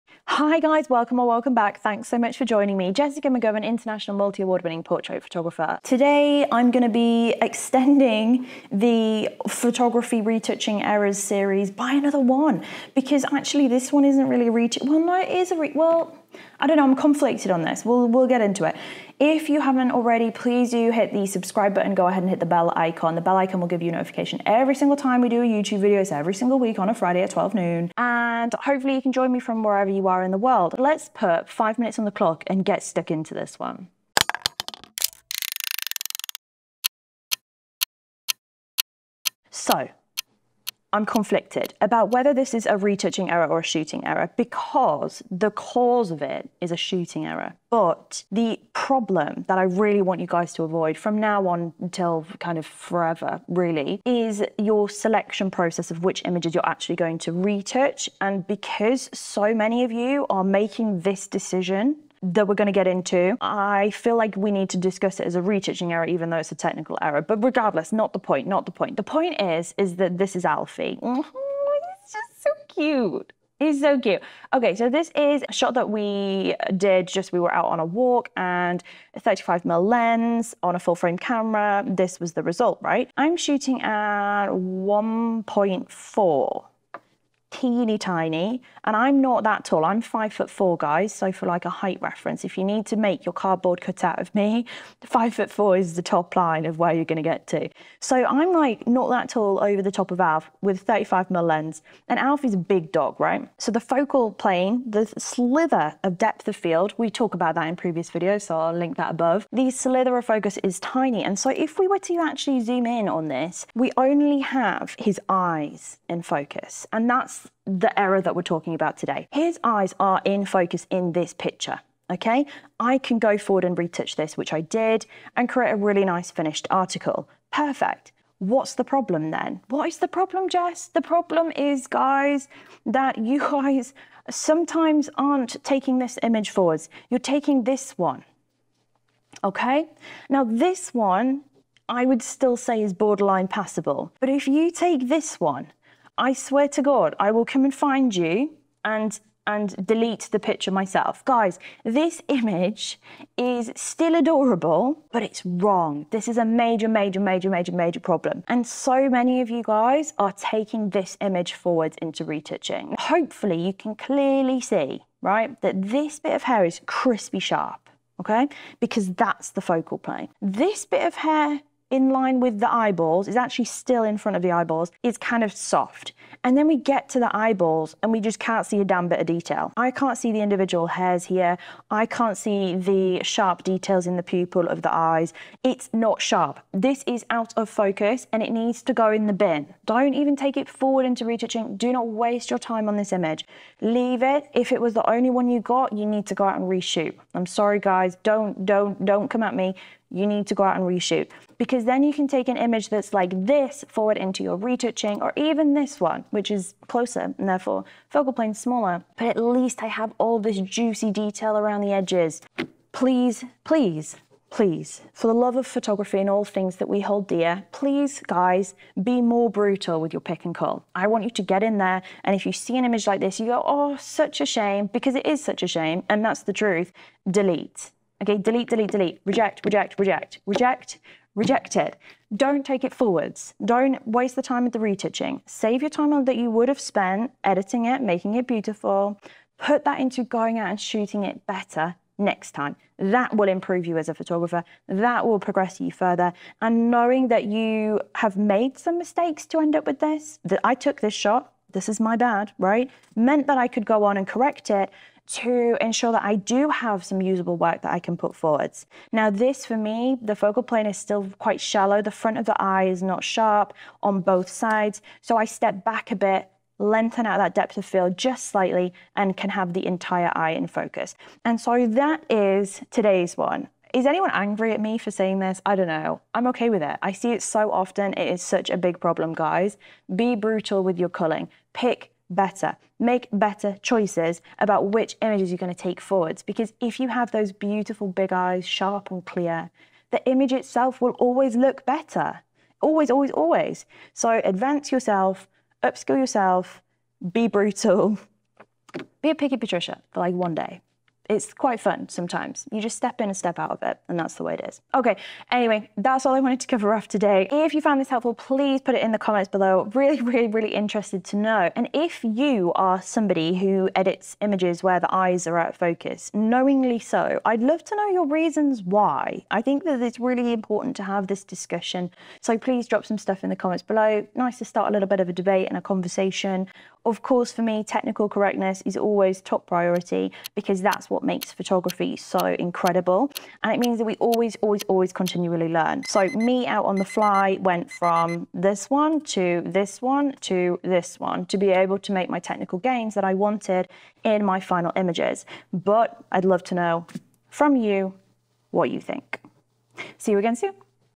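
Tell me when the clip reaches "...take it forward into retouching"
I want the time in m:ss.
3:10.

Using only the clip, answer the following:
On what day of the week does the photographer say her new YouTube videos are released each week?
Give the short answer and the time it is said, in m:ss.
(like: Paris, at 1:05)
Friday, at 0:26.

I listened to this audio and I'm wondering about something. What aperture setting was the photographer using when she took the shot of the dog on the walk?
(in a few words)
1.4.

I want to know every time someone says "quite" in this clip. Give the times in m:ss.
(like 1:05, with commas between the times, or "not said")
4:21, 5:01.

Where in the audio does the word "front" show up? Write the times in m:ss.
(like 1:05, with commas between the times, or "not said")
2:54, 4:22.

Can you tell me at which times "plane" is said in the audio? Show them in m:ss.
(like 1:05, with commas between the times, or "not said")
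1:44, 2:49, 3:28, 4:20.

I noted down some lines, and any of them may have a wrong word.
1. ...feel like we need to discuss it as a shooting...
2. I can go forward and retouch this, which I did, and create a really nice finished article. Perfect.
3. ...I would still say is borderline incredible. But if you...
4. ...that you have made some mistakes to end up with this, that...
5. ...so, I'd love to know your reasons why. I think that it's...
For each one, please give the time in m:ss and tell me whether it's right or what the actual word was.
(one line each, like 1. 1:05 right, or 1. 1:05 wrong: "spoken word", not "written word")
1. 1:03 wrong: "retouching", not "shooting"
2. 2:02 right
3. 2:21 wrong: "passable", not "incredible"
4. 4:07 right
5. 5:16 right.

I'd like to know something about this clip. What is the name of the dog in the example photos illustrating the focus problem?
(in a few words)
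Alfie.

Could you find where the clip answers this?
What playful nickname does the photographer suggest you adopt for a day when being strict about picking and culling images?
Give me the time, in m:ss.
4:59.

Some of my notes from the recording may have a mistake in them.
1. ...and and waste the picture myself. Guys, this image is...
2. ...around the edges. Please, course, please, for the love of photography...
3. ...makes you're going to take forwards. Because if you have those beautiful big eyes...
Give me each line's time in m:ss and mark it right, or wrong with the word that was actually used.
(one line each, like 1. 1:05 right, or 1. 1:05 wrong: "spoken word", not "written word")
1. 2:28 wrong: "delete", not "waste"
2. 3:31 wrong: "please", not "course"
3. 4:45 wrong: "images", not "makes".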